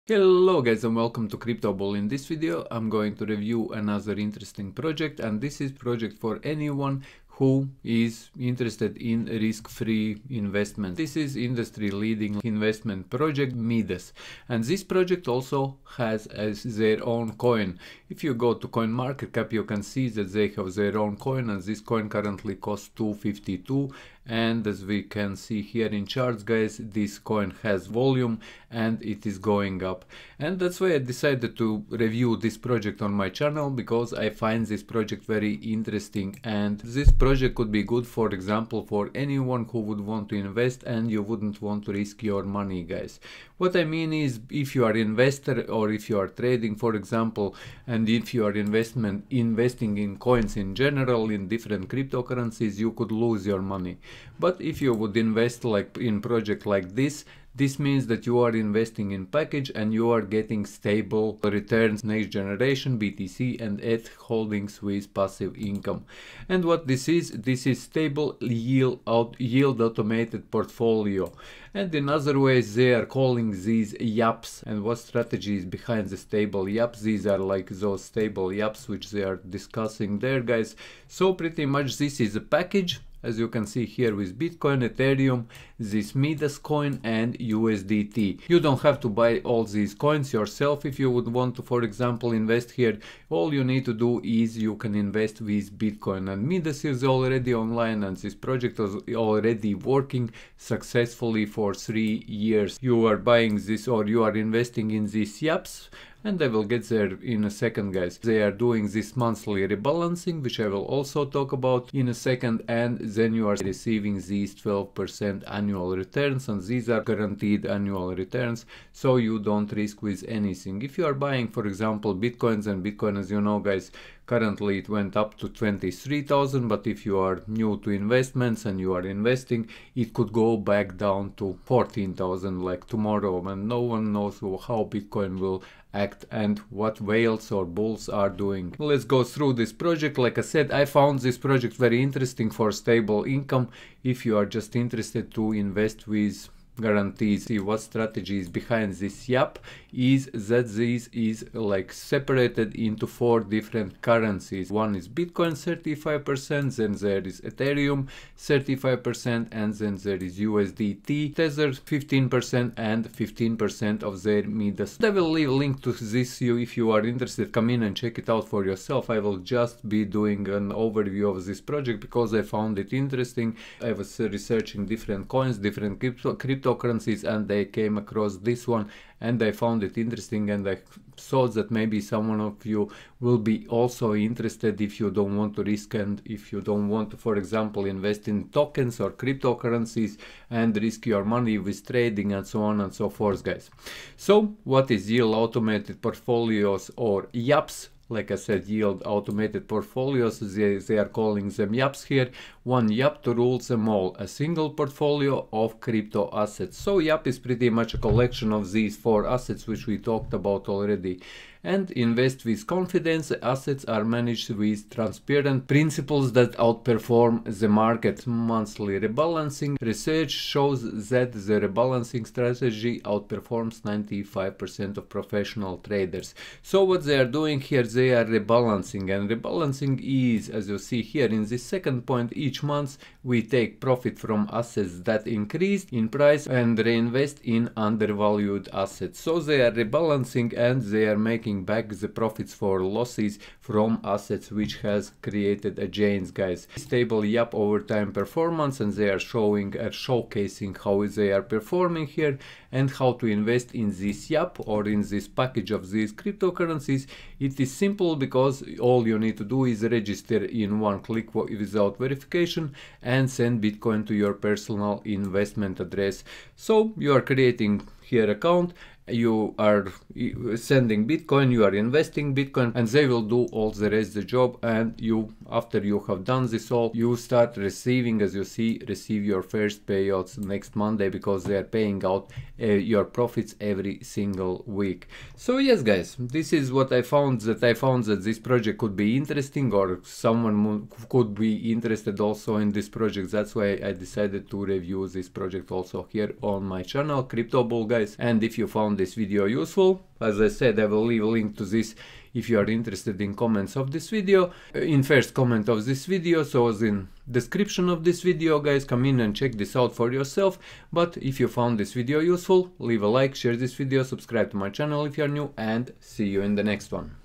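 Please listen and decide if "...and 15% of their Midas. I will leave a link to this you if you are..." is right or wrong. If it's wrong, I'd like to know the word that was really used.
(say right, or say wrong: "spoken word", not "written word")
right.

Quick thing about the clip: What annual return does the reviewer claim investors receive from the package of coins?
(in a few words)
12%.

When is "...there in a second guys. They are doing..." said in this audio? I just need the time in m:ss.
1:46.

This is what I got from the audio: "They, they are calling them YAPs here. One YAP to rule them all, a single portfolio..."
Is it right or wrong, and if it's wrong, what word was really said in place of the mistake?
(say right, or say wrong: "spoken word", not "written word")
right.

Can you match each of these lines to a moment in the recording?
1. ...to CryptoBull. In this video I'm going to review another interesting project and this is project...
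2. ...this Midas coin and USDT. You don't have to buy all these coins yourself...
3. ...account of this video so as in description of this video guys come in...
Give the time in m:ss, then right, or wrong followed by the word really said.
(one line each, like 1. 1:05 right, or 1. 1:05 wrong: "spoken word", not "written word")
1. 0:01 right
2. 1:25 right
3. 5:05 wrong: "comment", not "account".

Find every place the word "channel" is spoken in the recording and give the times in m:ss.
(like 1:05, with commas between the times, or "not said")
0:33, 4:56, 5:14.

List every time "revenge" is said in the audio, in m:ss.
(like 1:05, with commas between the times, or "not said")
not said.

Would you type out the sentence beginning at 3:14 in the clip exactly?
So what is Yield Automated Portfolios or YAPS?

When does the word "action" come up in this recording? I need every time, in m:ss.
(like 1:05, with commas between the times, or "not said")
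not said.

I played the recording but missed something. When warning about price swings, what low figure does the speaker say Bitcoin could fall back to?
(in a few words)
14,000.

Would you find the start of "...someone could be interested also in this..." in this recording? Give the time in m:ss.
4:50.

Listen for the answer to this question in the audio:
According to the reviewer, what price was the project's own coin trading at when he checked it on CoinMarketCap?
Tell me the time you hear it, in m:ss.
0:22.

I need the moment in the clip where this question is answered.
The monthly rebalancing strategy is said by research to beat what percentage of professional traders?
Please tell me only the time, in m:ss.
3:43.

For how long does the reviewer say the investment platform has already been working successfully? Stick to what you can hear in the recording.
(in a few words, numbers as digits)
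3 years.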